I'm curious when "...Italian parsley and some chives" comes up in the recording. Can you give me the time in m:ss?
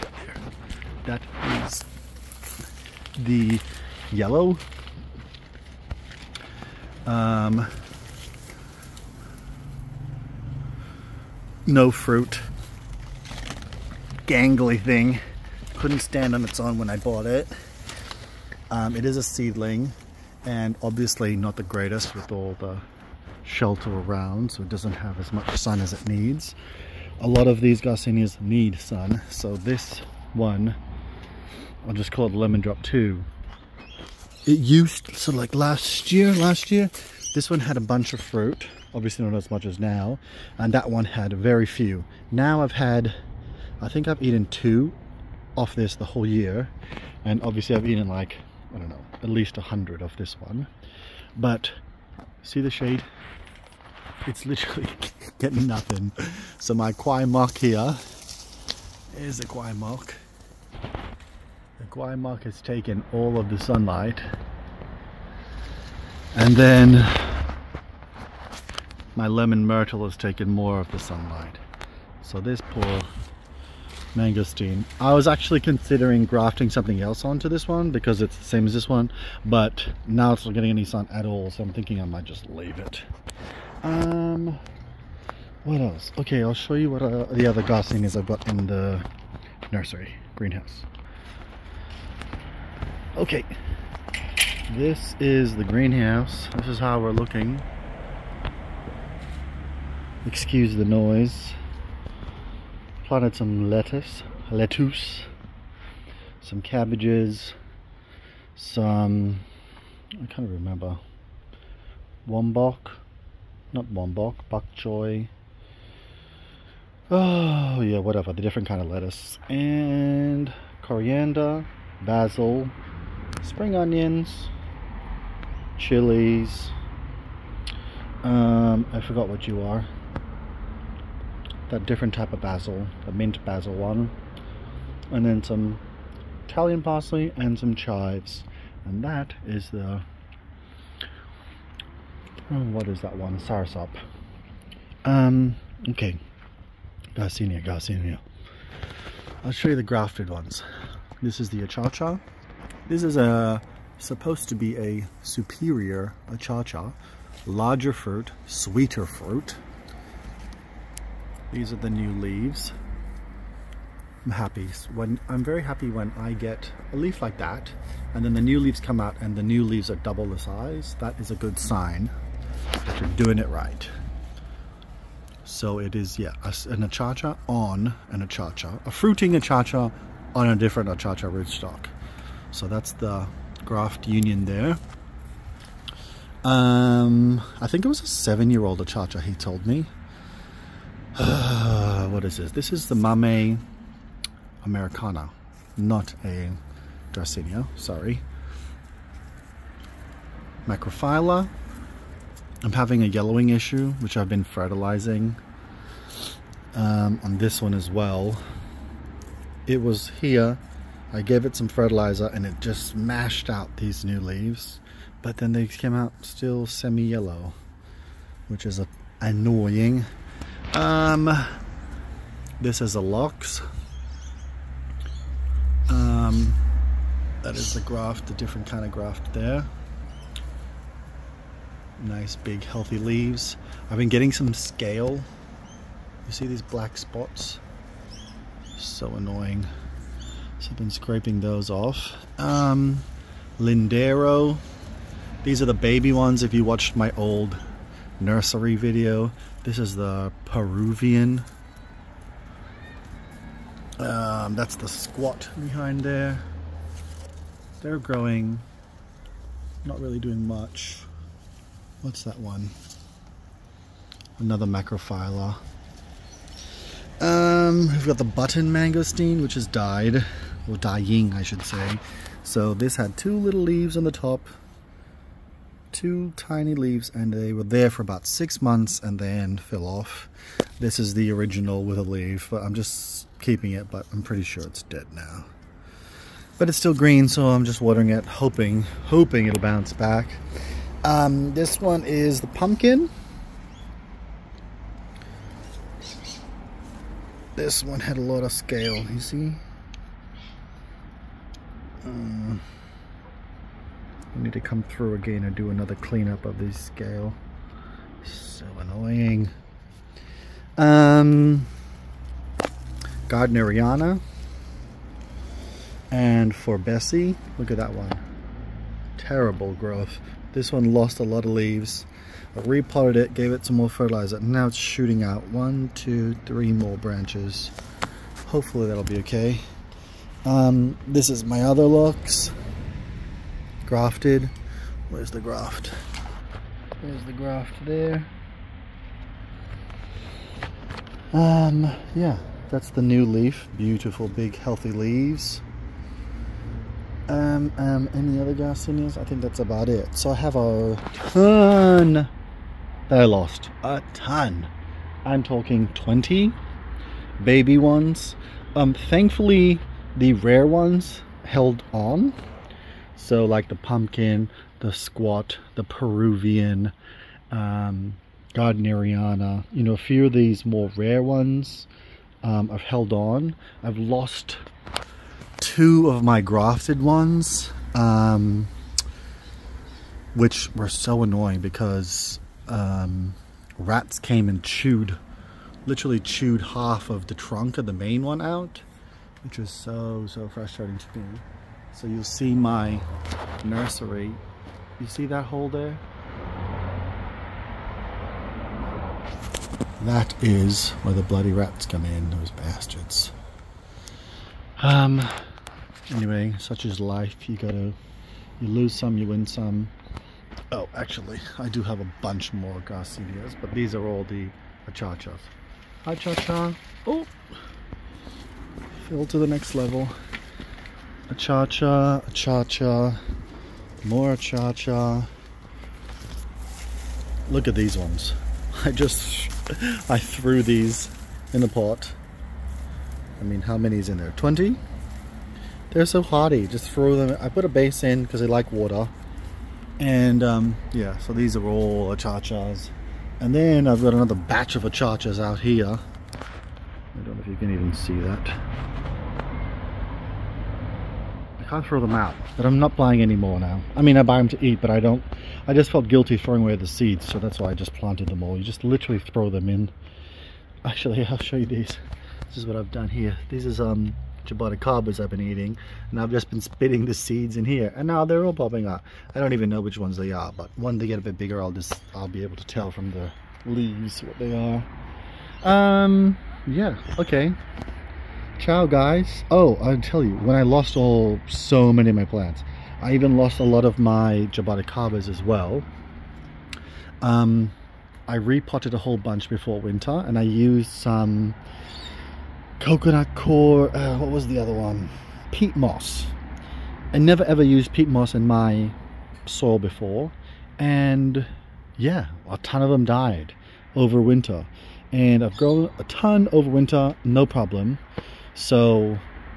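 2:16.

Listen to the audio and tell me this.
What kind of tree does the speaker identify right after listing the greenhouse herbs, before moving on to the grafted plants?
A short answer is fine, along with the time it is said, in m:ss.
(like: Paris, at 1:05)
Soursop, at 2:23.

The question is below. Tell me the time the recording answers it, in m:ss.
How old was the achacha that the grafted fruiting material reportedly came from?
3:08.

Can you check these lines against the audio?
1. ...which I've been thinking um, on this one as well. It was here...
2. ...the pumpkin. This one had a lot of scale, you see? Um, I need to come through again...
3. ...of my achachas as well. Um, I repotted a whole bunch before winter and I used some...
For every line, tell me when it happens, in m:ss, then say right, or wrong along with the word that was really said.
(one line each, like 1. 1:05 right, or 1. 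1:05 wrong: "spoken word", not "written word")
1. 3:23 wrong: "fertilizing", not "thinking"
2. 4:52 right
3. 8:03 wrong: "jaboticabas", not "achachas".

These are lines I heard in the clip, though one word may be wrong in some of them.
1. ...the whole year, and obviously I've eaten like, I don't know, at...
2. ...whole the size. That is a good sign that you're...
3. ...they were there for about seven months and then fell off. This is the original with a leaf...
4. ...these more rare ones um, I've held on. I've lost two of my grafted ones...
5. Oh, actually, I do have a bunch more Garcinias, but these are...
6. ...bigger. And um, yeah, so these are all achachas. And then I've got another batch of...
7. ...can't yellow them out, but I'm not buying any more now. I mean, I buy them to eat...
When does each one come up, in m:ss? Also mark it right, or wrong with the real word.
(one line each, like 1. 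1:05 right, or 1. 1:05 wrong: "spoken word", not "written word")
1. 0:45 right
2. 2:49 wrong: "double", not "whole"
3. 4:37 wrong: "six", not "seven"
4. 6:10 right
5. 6:50 right
6. 7:18 wrong: "water", not "bigger"
7. 7:31 wrong: "throw", not "yellow".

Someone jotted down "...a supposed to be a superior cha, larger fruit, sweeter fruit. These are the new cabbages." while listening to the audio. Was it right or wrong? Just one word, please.
wrong.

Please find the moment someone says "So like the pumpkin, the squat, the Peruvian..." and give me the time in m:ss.
6:03.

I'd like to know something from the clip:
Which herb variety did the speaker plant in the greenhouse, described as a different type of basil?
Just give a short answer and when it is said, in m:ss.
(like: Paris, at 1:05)
Mint basil, at 2:13.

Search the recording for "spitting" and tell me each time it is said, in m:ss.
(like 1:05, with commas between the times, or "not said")
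7:46.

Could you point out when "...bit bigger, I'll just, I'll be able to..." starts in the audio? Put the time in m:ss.
7:51.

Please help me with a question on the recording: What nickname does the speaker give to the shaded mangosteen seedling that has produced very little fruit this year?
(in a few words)
Lemon Drop 2.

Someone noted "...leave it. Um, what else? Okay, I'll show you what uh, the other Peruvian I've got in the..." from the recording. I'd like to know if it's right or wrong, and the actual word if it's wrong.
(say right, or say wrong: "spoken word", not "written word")
wrong: "Garcinias", not "Peruvian".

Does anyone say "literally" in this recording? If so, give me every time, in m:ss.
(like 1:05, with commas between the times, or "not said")
0:54, 6:25, 7:38.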